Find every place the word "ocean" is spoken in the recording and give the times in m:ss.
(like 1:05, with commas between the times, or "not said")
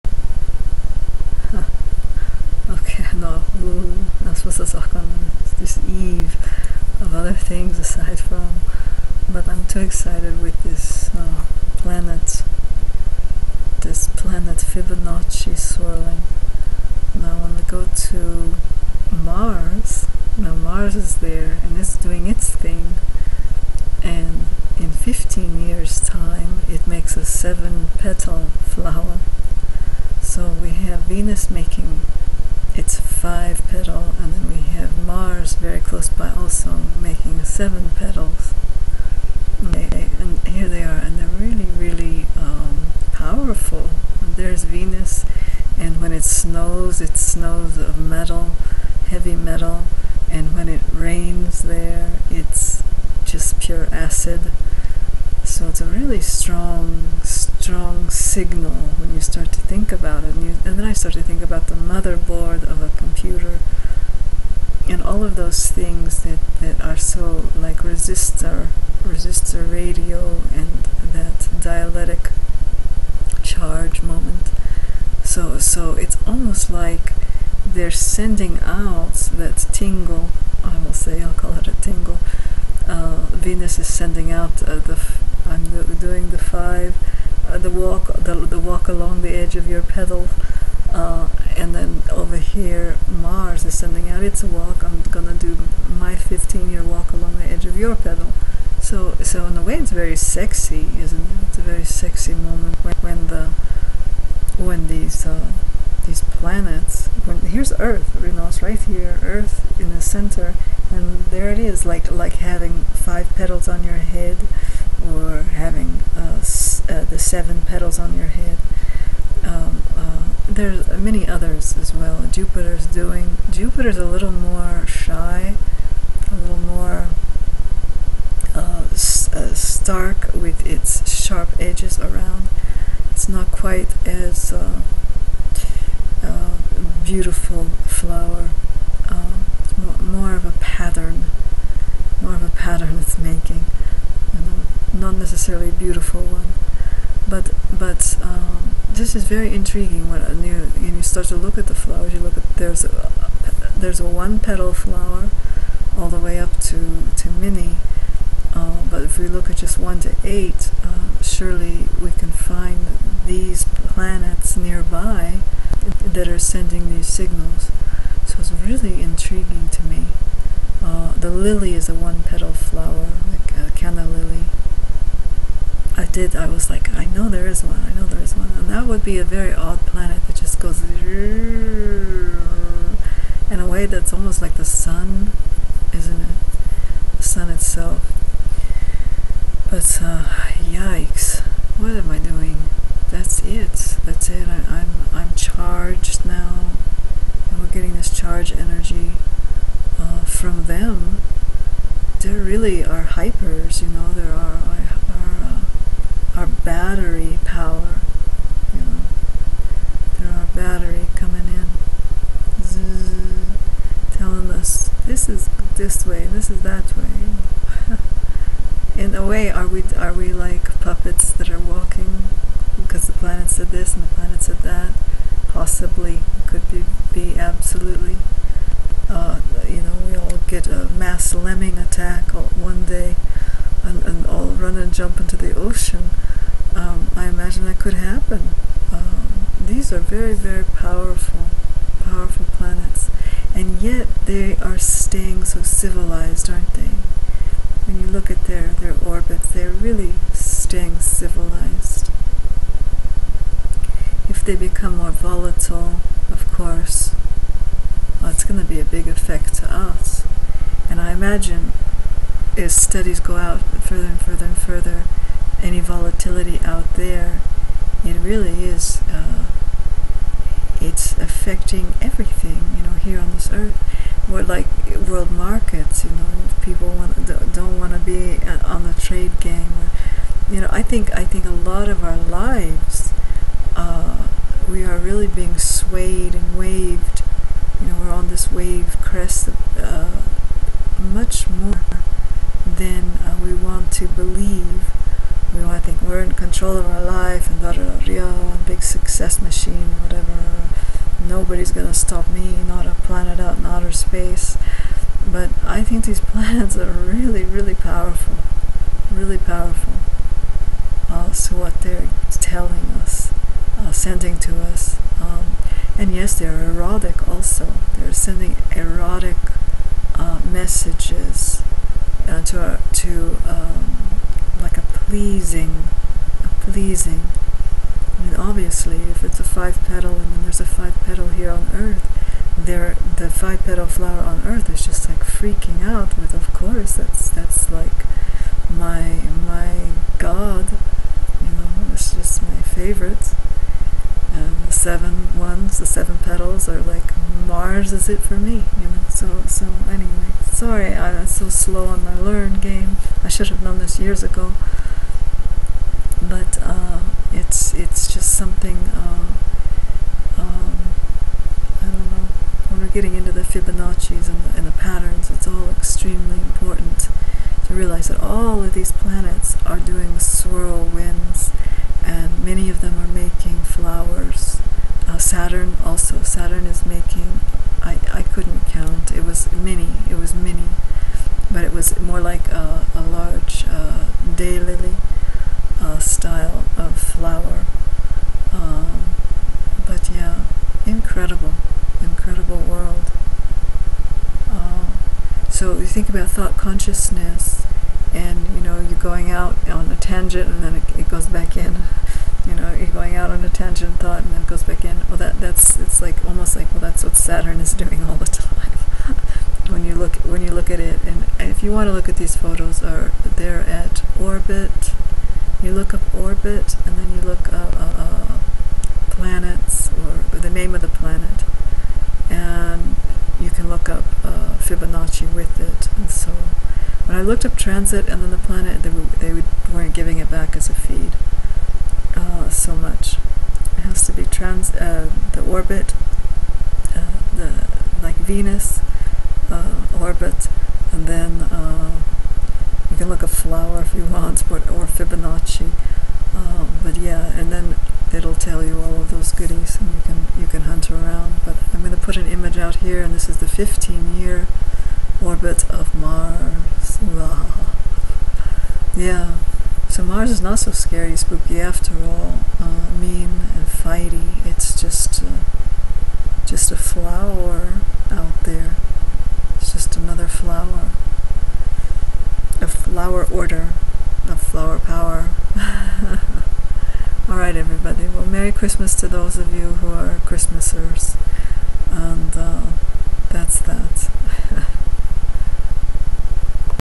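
3:55.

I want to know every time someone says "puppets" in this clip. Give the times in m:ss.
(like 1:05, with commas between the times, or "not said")
3:40.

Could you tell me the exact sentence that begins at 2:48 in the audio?
So it's really intriguing to me.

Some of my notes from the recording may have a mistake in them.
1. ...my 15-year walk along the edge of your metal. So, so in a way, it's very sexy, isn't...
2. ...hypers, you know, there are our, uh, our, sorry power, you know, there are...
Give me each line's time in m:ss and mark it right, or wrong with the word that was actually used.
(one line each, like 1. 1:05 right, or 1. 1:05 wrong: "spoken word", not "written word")
1. 1:35 wrong: "petal", not "metal"
2. 3:23 wrong: "battery", not "sorry".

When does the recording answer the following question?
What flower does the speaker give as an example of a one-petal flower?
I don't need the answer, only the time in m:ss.
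2:53.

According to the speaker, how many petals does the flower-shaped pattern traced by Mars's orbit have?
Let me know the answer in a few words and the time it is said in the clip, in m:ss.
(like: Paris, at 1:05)
7, at 0:27.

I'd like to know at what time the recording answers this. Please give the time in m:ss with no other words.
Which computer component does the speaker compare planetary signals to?
1:01.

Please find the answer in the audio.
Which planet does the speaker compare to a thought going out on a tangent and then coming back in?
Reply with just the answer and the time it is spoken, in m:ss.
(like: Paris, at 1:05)
Saturn, at 6:47.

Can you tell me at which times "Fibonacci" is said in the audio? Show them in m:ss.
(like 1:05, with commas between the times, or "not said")
0:14, 6:03, 7:04, 7:24.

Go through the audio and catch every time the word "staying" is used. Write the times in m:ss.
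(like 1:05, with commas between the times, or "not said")
4:04, 4:10.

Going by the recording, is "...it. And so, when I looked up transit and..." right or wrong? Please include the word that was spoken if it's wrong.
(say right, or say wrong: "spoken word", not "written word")
right.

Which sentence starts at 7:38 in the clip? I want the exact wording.
Yeah, so Mars is not so scary, spooky after all, uh, mean and fighty.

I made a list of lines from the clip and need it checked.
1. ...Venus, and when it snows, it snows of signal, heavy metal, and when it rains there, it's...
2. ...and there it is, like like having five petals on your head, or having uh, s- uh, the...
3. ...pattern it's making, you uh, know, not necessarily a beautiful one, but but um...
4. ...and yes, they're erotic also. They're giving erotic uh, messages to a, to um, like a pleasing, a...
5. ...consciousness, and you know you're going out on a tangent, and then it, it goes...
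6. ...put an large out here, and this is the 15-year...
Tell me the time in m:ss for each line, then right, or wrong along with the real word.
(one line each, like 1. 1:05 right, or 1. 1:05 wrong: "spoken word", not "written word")
1. 0:44 wrong: "metal", not "signal"
2. 1:50 right
3. 2:22 right
4. 5:15 wrong: "sending", not "giving"
5. 6:36 right
6. 7:31 wrong: "image", not "large".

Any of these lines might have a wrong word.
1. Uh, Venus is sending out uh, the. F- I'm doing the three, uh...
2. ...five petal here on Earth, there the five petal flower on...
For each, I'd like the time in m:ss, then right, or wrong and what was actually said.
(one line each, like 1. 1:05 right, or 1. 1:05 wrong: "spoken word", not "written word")
1. 1:22 wrong: "five", not "three"
2. 5:30 right.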